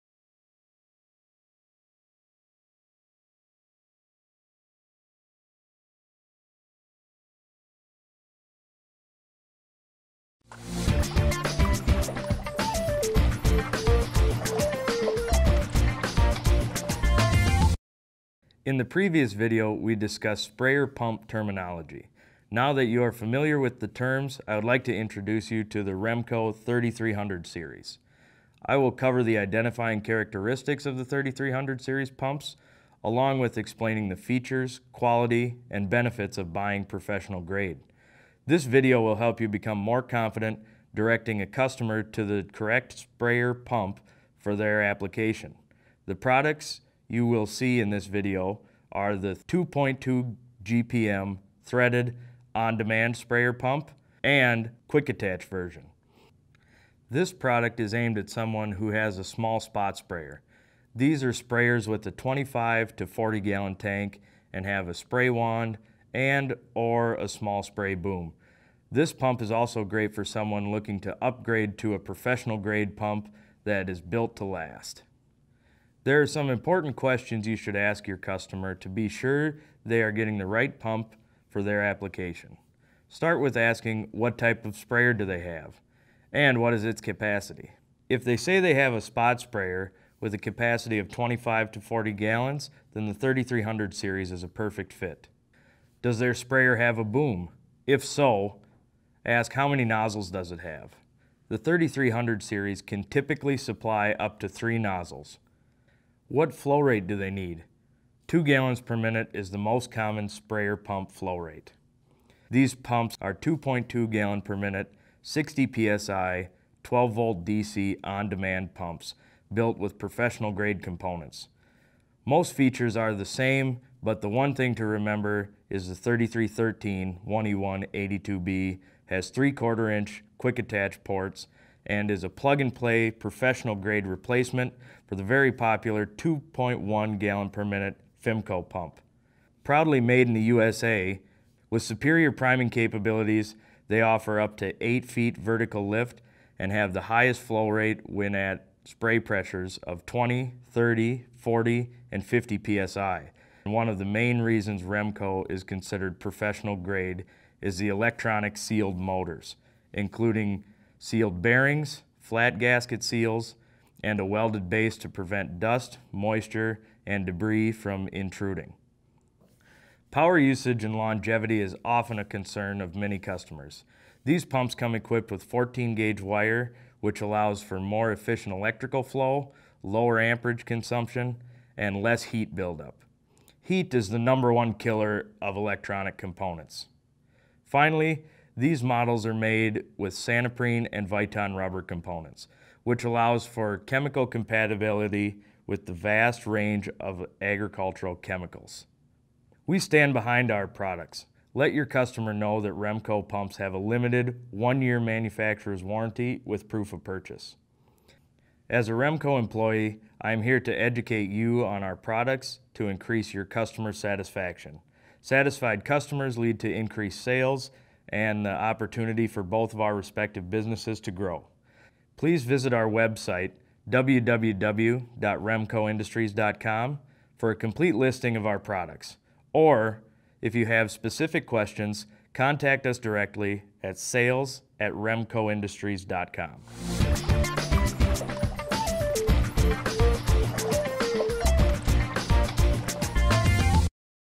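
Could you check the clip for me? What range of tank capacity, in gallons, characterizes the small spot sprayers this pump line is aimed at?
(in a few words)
25 to 40 gallons.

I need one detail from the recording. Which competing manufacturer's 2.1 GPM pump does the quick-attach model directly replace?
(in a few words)
Fimco.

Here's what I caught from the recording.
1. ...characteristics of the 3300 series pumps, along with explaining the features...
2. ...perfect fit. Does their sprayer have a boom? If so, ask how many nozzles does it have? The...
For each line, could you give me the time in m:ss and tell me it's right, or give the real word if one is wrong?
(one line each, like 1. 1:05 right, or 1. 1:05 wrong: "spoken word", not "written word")
1. 0:30 right
2. 1:34 right.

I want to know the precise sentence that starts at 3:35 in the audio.
Satisfied customers lead to increased sales, and the opportunity for both of our respective businesses to grow.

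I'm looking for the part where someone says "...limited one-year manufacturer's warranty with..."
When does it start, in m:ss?
3:23.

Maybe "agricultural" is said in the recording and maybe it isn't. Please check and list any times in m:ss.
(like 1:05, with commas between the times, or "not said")
3:17.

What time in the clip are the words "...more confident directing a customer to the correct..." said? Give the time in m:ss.
0:39.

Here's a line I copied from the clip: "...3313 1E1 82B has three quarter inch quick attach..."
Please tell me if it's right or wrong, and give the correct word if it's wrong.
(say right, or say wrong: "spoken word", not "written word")
right.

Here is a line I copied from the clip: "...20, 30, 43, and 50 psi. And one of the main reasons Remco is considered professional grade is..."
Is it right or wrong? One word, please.
wrong.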